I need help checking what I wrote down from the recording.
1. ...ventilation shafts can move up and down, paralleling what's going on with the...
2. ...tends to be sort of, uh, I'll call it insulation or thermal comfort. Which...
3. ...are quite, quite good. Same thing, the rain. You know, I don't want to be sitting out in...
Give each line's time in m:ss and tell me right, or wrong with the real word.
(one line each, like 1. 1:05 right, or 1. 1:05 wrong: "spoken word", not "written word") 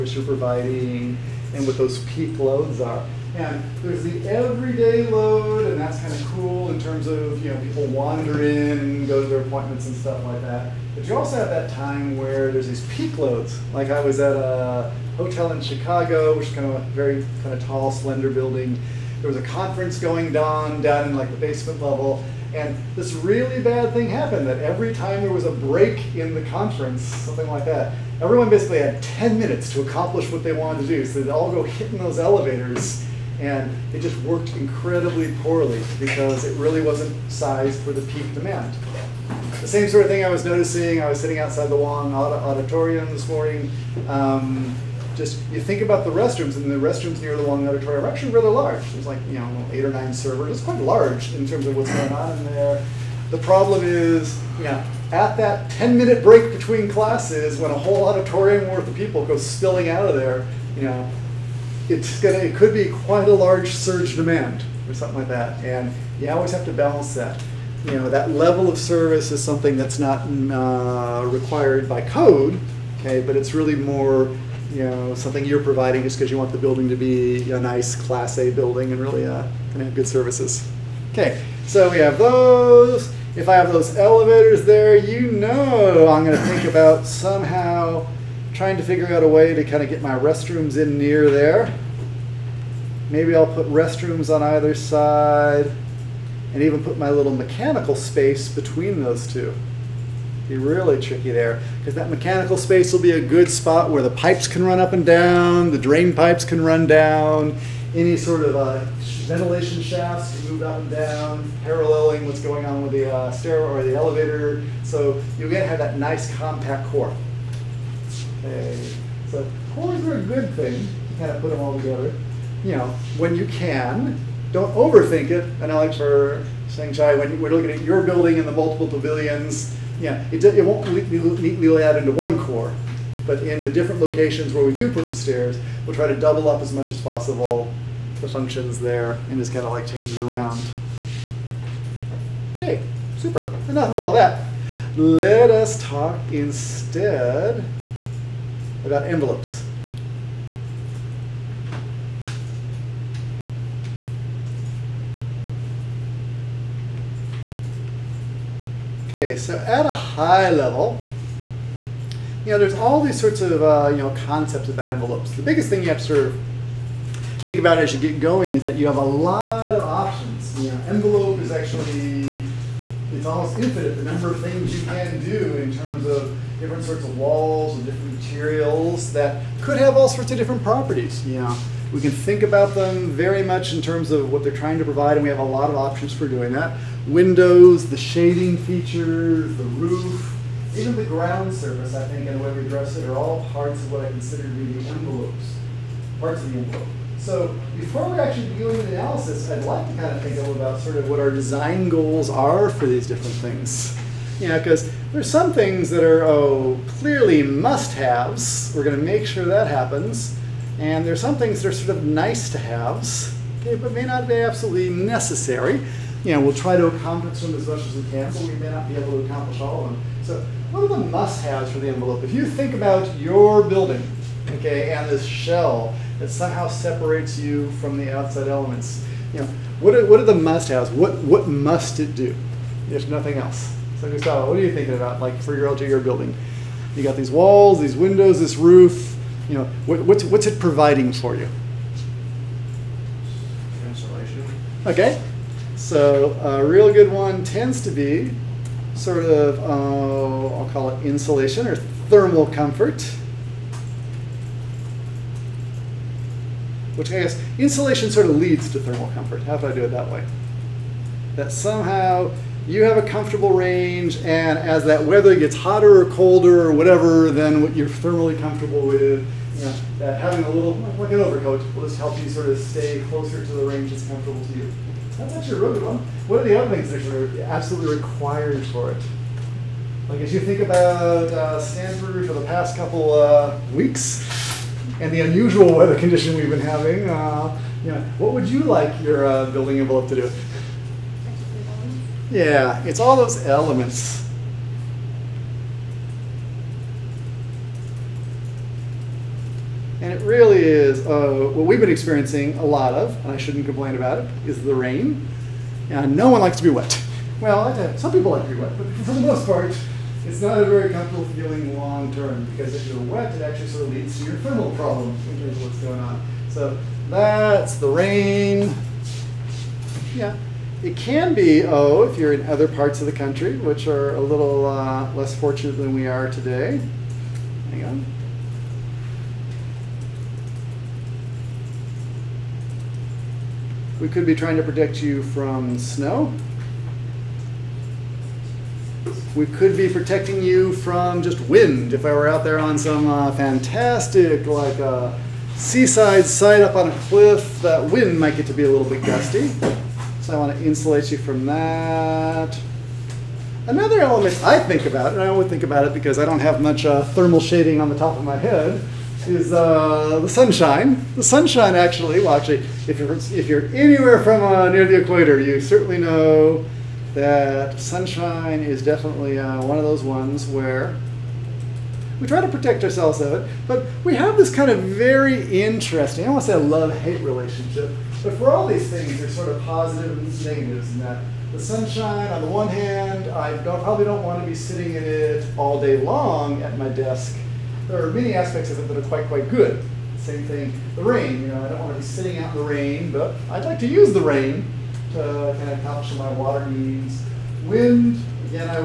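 1. 1:49 right
2. 4:07 right
3. 6:29 right.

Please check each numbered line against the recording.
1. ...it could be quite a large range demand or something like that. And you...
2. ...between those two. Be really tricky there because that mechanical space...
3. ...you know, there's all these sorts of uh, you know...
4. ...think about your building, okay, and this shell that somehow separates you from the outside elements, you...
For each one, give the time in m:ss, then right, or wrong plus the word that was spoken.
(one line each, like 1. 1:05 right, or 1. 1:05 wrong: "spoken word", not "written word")
1. 1:02 wrong: "surge", not "range"
2. 1:38 right
3. 2:42 right
4. 3:42 right.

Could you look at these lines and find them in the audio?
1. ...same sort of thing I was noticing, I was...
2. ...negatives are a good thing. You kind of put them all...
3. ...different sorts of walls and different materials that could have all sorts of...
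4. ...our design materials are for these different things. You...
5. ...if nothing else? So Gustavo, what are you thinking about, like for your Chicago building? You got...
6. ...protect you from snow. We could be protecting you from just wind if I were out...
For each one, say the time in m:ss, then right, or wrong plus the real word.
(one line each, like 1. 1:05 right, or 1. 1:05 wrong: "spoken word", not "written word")
1. 0:39 right
2. 1:59 wrong: "cores", not "negatives"
3. 2:56 right
4. 3:21 wrong: "goals", not "materials"
5. 3:52 wrong: "LGR", not "Chicago"
6. 5:34 right.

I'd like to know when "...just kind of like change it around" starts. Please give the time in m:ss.
2:19.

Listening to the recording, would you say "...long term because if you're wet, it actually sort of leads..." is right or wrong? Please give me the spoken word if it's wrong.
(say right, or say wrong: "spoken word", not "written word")
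right.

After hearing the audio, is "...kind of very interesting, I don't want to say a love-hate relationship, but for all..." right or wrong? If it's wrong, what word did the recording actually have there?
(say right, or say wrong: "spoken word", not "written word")
right.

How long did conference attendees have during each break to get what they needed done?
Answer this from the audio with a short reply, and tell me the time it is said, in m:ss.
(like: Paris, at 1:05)
10 minutes, at 0:29.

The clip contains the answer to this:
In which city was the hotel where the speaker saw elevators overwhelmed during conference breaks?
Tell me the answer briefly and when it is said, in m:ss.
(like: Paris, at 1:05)
Chicago, at 0:15.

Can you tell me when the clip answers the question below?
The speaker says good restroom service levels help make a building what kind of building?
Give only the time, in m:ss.
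1:17.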